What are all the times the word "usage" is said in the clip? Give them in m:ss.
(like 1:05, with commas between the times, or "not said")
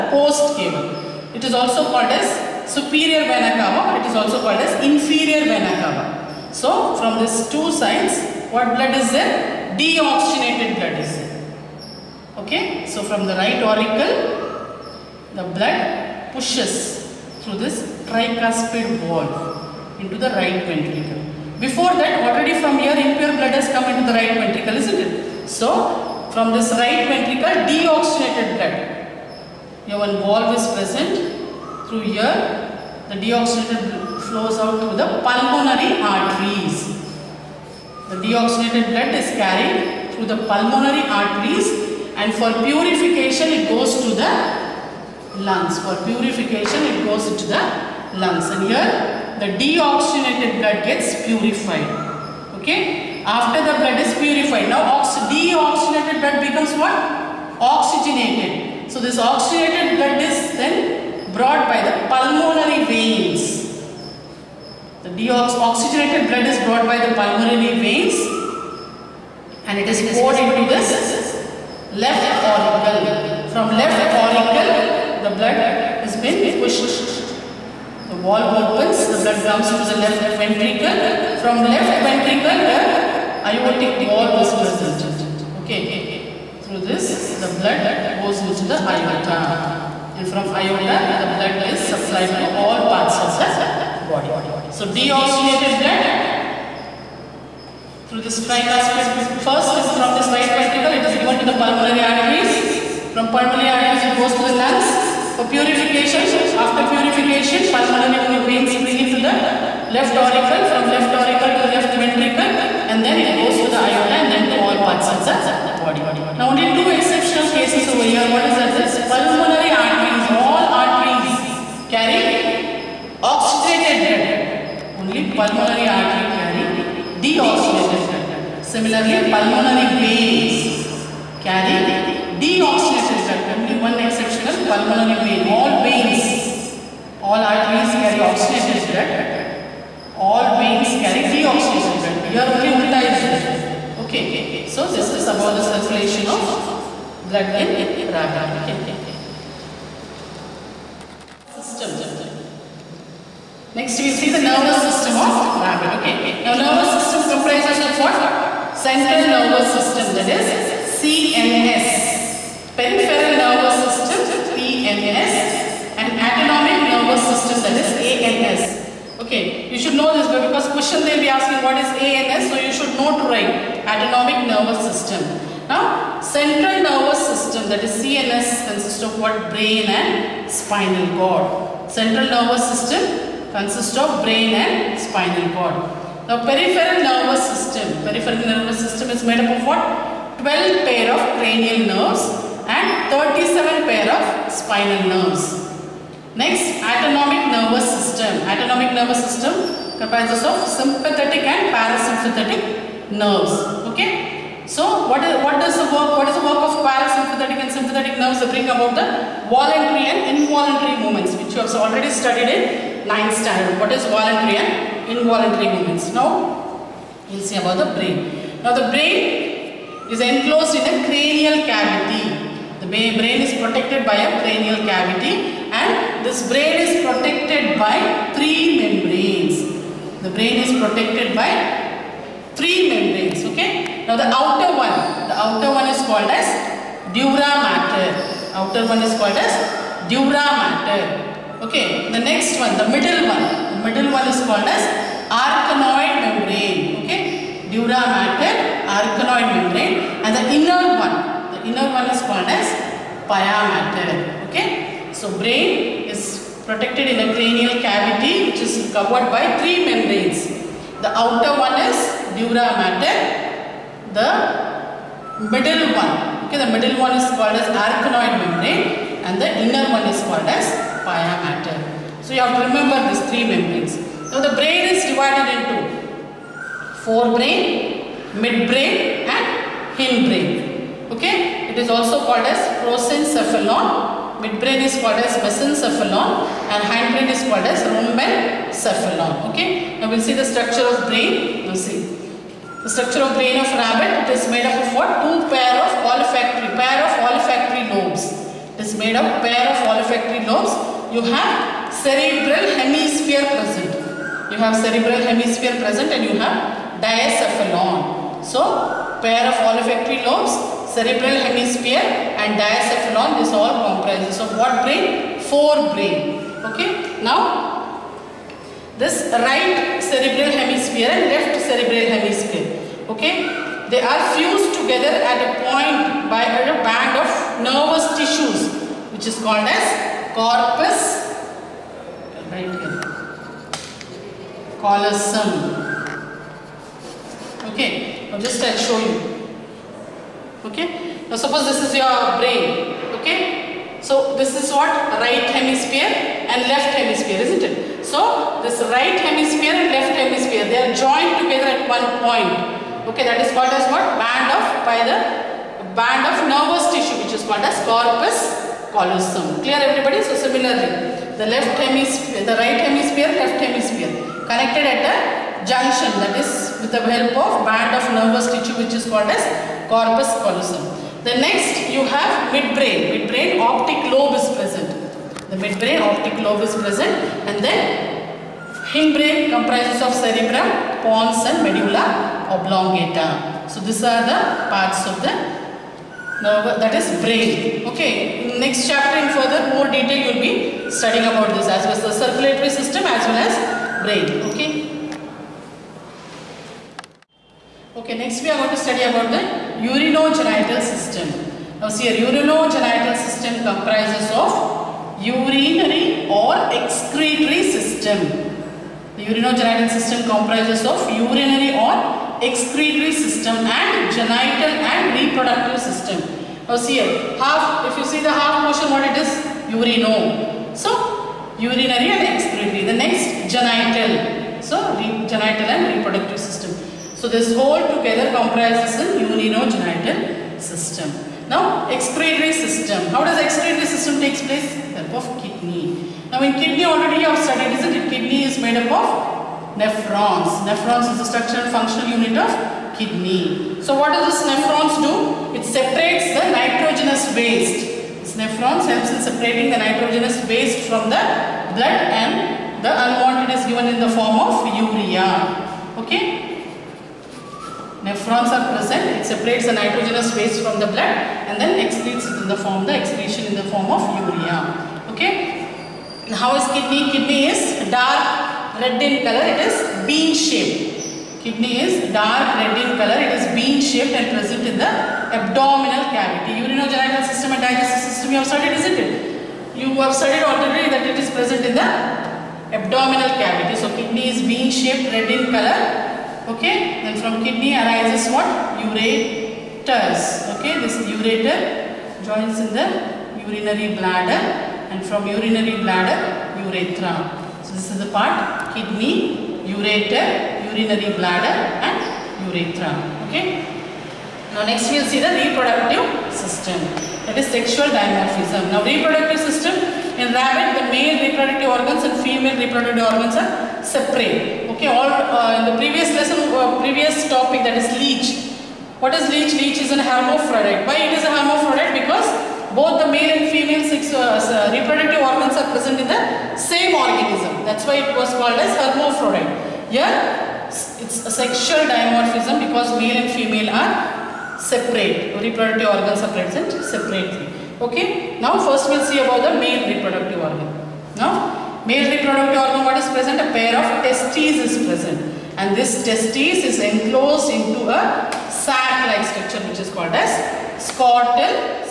not said.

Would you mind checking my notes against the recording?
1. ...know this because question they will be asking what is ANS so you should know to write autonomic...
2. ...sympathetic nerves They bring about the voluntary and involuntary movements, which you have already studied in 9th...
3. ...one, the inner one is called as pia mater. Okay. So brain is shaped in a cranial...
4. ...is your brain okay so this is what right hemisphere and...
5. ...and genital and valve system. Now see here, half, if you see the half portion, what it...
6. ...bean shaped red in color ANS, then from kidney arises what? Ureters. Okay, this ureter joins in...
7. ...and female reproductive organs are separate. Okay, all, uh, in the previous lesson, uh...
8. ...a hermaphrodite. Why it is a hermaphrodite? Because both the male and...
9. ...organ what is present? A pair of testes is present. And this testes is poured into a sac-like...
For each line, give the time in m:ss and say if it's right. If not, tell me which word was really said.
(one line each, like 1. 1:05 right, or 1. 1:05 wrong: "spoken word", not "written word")
1. 2:49 right
2. 3:27 right
3. 4:11 wrong: "protected", not "shaped"
4. 5:41 right
5. 6:53 wrong: "reproductive", not "valve"
6. 8:04 wrong: "Okay", not "ANS"
7. 8:32 right
8. 8:39 right
9. 9:02 wrong: "enclosed", not "poured".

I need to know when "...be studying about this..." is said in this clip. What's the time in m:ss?
6:30.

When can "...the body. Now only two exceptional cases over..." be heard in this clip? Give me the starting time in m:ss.
1:55.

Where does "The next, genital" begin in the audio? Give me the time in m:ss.
7:02.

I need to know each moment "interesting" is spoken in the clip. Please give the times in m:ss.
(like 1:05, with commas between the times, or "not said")
not said.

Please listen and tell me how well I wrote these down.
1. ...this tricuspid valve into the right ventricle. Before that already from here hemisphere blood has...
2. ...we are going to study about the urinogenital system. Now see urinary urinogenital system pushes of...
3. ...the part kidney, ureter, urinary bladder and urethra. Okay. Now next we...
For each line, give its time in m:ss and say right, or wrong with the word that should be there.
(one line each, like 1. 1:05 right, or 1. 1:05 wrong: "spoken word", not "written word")
1. 0:17 wrong: "impure", not "hemisphere"
2. 6:38 wrong: "comprises", not "pushes"
3. 8:17 right.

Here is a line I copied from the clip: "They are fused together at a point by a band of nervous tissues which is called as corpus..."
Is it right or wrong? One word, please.
right.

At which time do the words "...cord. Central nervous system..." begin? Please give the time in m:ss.
3:01.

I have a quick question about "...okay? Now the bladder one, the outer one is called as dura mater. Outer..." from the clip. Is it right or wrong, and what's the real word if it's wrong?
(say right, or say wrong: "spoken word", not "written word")
wrong: "outer", not "bladder".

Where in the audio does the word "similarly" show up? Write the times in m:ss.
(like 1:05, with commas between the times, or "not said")
2:08, 6:00.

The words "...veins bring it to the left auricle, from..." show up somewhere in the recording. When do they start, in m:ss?
1:48.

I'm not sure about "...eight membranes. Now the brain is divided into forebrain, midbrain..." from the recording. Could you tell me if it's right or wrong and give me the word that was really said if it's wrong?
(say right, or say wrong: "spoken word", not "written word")
wrong: "three", not "eight".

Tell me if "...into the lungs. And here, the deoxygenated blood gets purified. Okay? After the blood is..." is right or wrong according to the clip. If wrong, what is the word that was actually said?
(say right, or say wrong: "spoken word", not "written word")
right.